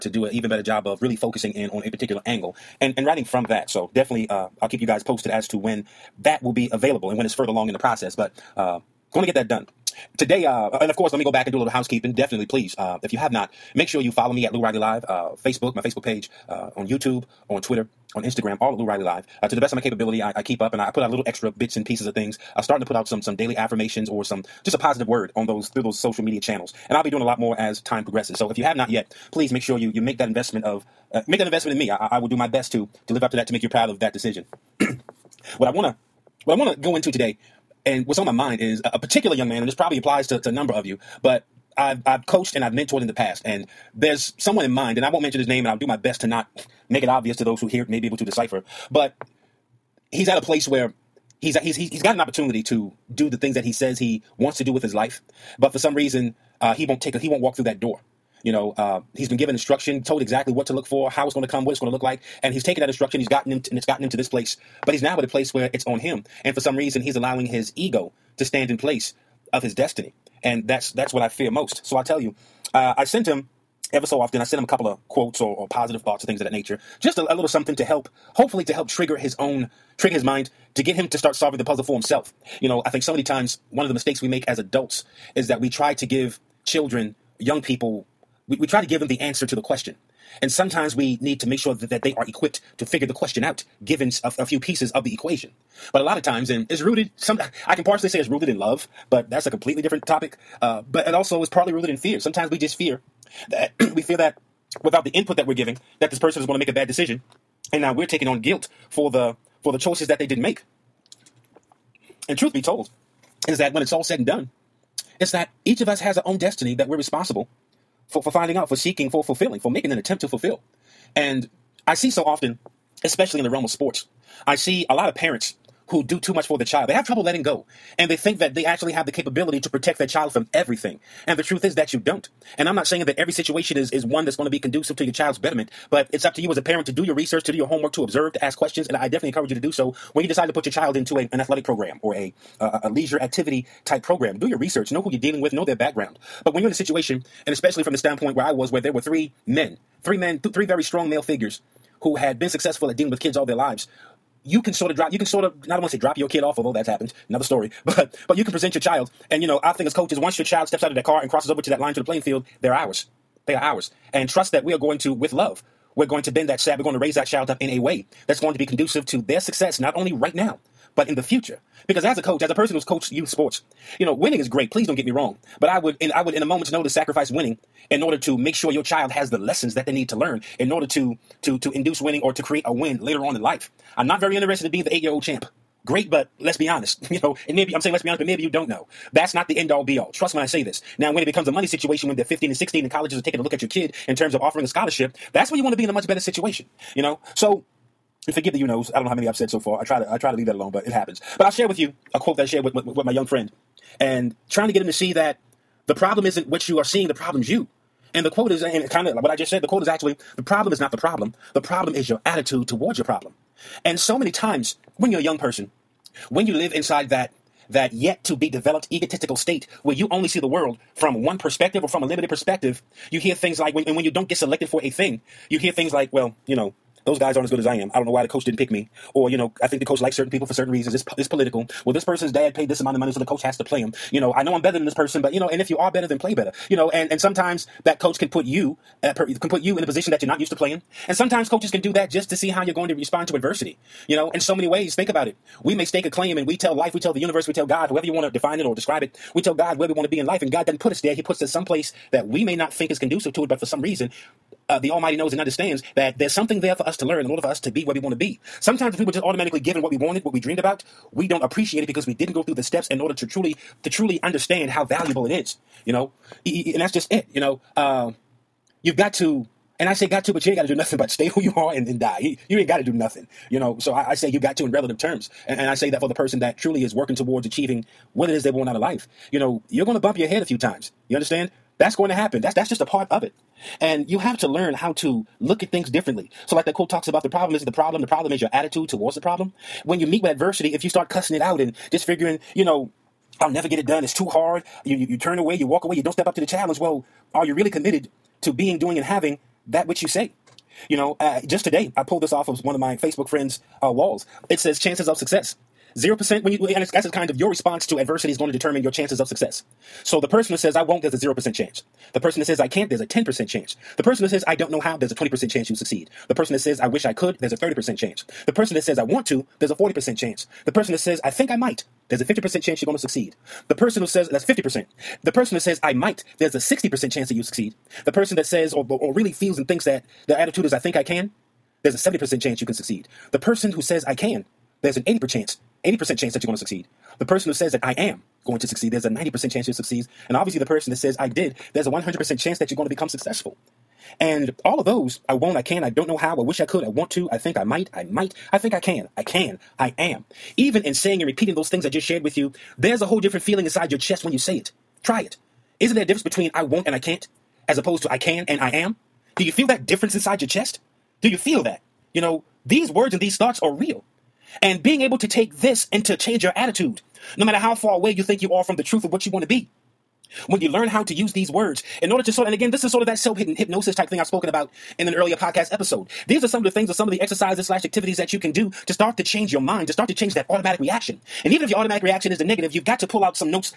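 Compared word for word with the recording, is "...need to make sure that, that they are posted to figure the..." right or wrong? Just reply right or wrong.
wrong.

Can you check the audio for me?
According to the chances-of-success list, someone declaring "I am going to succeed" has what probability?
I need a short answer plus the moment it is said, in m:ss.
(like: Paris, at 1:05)
90%, at 5:39.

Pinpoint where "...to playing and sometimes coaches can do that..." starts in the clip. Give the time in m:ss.
4:00.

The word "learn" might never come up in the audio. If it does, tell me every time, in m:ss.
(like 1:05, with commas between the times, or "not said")
3:00, 4:17, 4:44, 6:10.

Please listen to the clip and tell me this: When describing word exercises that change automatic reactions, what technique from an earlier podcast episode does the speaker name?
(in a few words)
self hypnosis.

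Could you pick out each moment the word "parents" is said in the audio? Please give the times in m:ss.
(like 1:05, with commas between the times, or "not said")
2:05, 2:16.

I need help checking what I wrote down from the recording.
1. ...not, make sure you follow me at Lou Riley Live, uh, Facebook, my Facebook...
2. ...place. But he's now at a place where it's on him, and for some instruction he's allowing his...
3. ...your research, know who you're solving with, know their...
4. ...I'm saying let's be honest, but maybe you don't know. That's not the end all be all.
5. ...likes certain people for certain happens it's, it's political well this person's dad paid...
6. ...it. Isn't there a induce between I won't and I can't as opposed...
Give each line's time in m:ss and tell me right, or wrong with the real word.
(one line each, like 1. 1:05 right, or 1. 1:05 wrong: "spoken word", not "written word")
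1. 0:13 right
2. 1:04 wrong: "reason", not "instruction"
3. 2:24 wrong: "dealing", not "solving"
4. 3:07 right
5. 3:50 wrong: "reasons", not "happens"
6. 5:55 wrong: "difference", not "induce".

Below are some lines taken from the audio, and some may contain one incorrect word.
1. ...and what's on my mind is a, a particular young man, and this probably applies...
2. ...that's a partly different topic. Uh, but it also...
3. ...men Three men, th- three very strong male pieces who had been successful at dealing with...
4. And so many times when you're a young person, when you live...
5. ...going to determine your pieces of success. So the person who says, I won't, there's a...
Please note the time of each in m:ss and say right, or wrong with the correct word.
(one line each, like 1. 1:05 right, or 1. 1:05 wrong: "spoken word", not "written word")
1. 0:37 right
2. 1:39 wrong: "completely", not "partly"
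3. 2:29 wrong: "figures", not "pieces"
4. 3:33 right
5. 5:08 wrong: "chances", not "pieces".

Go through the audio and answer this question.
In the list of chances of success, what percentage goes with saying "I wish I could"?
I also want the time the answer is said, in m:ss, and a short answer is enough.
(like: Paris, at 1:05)
30%, at 5:17.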